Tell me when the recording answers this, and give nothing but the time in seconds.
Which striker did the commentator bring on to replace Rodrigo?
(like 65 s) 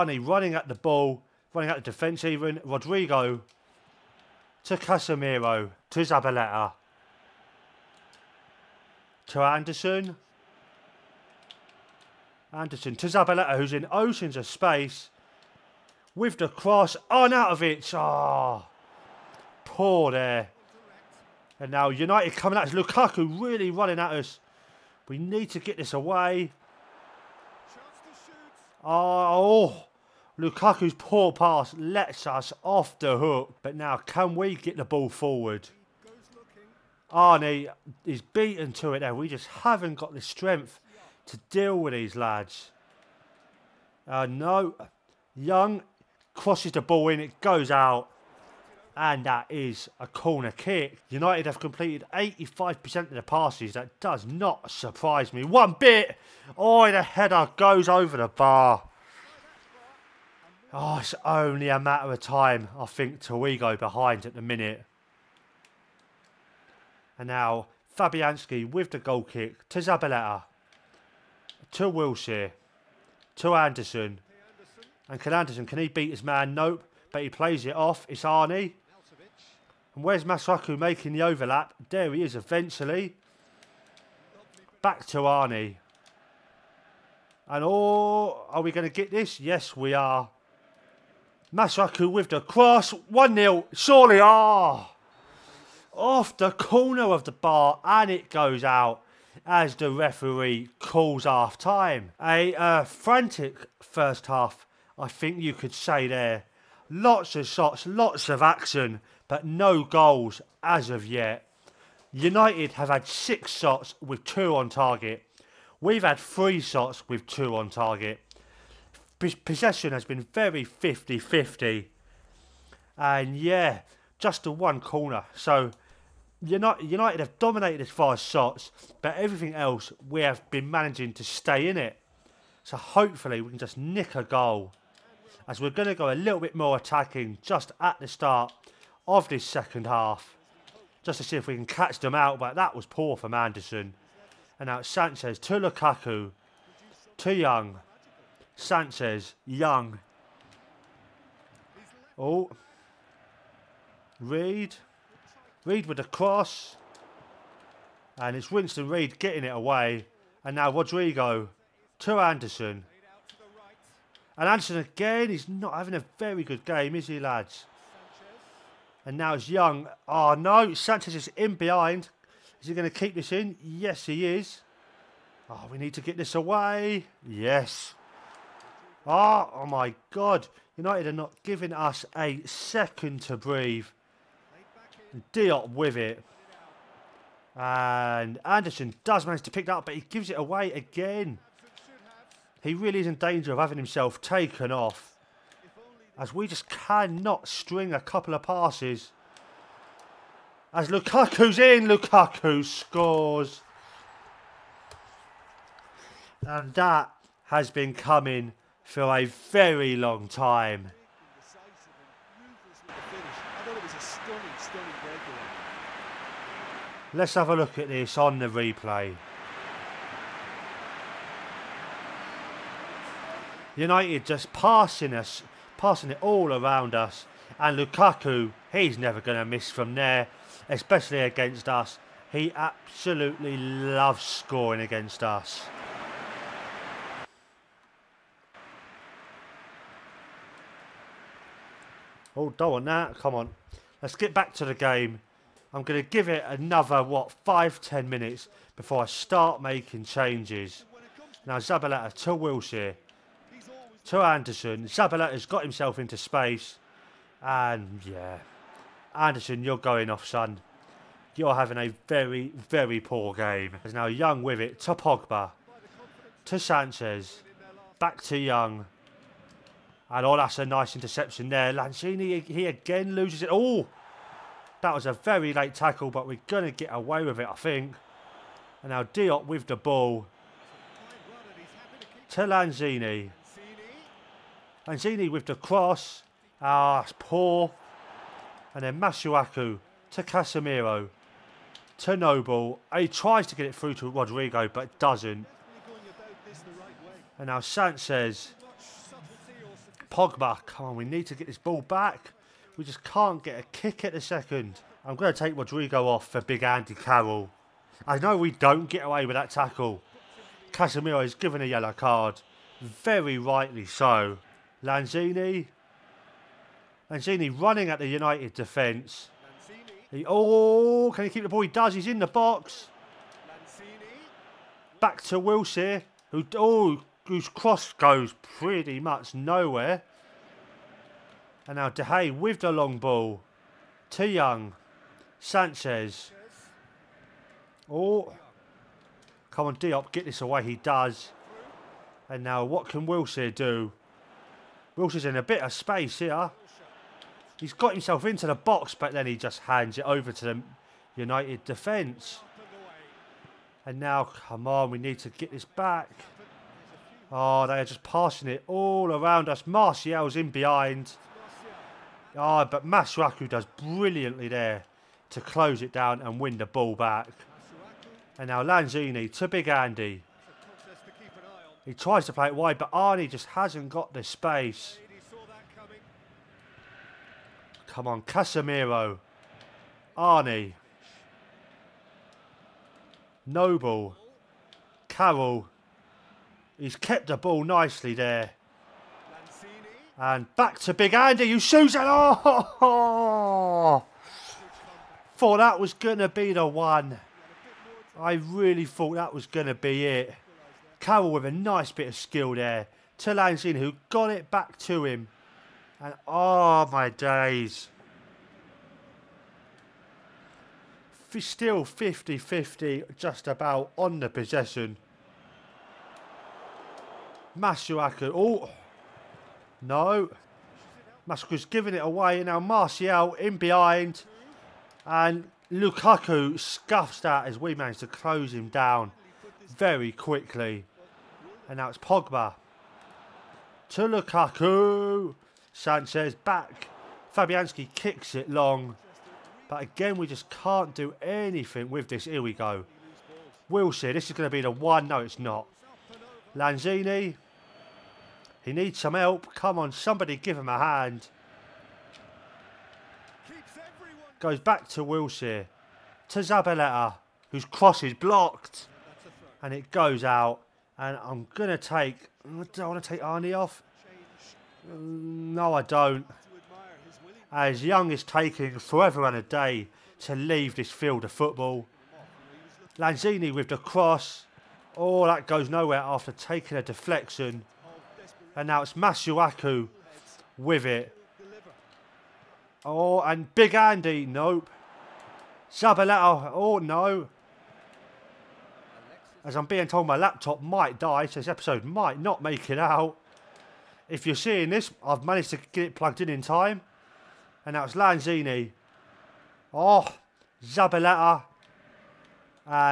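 306 s.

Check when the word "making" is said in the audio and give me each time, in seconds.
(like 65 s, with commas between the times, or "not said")
80 s, 249 s.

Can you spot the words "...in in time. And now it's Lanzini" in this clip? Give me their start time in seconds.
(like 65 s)
496 s.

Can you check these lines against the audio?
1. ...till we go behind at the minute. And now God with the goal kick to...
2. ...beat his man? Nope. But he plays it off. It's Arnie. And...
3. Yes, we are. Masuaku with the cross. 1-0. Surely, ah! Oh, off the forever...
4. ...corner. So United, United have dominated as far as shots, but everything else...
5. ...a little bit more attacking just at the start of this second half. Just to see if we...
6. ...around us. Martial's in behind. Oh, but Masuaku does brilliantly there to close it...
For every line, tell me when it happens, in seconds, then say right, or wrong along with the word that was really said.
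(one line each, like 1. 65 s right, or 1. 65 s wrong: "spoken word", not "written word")
1. 63 s wrong: "Fabianski", not "God"
2. 75 s right
3. 89 s wrong: "corner", not "forever"
4. 124 s right
5. 136 s right
6. 359 s right.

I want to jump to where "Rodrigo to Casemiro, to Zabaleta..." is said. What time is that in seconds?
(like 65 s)
2 s.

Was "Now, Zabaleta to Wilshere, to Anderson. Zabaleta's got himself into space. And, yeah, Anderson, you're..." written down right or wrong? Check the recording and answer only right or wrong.
right.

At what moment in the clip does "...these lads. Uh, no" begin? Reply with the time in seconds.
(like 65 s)
41 s.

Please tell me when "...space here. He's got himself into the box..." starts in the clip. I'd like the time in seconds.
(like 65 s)
345 s.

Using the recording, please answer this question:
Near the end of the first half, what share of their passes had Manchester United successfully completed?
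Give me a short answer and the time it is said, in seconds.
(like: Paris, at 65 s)
85%, at 52 s.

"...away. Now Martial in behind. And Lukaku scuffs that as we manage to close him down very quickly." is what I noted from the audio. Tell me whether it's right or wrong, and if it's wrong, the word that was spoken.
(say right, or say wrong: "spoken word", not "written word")
right.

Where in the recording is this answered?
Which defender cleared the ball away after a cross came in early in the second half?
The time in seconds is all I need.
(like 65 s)
158 s.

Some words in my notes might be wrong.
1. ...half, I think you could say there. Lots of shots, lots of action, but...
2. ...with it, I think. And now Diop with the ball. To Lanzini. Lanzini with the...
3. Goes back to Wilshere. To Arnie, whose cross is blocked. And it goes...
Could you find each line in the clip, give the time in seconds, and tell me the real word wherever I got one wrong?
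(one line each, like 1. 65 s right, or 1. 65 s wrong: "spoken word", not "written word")
1. 104 s right
2. 277 s right
3. 454 s wrong: "Zabaleta", not "Arnie".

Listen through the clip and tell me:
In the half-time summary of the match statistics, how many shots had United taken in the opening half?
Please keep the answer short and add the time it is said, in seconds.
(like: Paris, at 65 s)
6, at 113 s.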